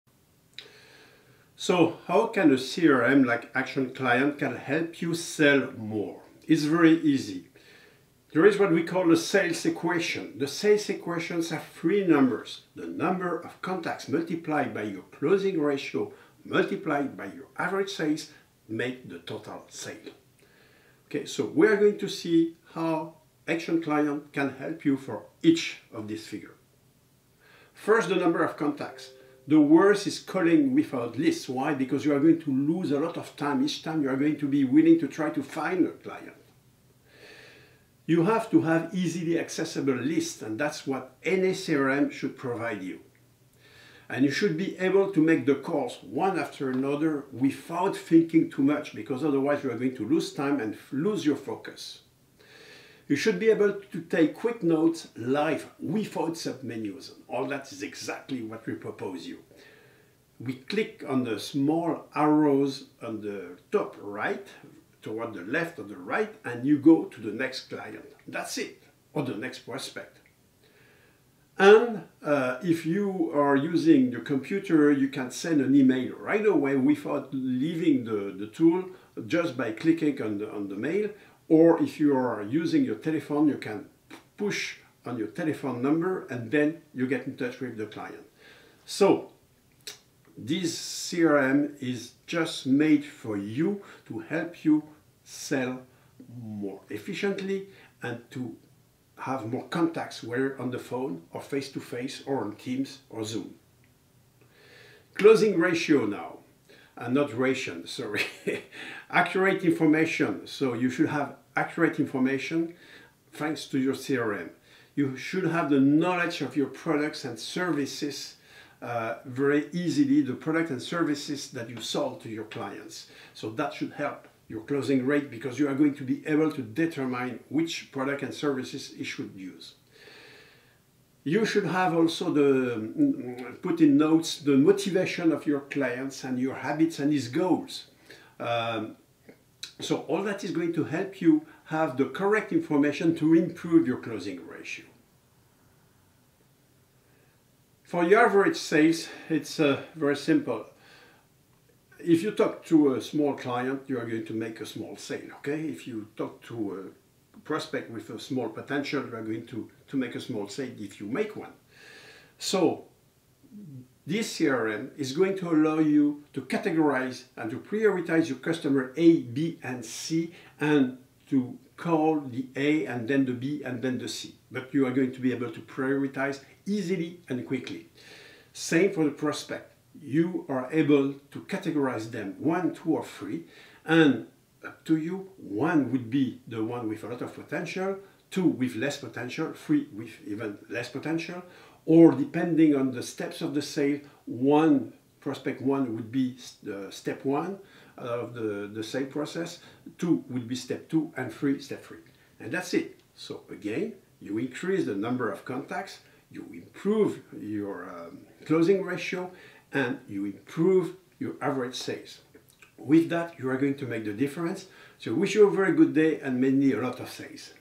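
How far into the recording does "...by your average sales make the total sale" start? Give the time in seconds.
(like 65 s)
17 s.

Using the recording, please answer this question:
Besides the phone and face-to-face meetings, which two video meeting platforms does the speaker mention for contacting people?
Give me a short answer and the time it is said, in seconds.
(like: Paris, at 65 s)
Teams or Zoom, at 102 s.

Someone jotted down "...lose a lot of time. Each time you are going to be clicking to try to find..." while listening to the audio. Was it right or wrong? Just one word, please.
wrong.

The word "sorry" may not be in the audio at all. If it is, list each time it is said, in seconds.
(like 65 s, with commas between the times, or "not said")
107 s.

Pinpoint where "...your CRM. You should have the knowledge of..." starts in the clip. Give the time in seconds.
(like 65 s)
113 s.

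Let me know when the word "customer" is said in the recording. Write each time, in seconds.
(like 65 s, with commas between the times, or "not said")
168 s.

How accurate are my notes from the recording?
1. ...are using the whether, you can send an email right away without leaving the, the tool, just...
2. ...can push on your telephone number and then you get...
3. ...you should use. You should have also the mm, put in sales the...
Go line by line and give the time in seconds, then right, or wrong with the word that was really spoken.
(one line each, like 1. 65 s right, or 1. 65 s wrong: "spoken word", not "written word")
1. 73 s wrong: "computer", not "whether"
2. 83 s right
3. 128 s wrong: "notes", not "sales".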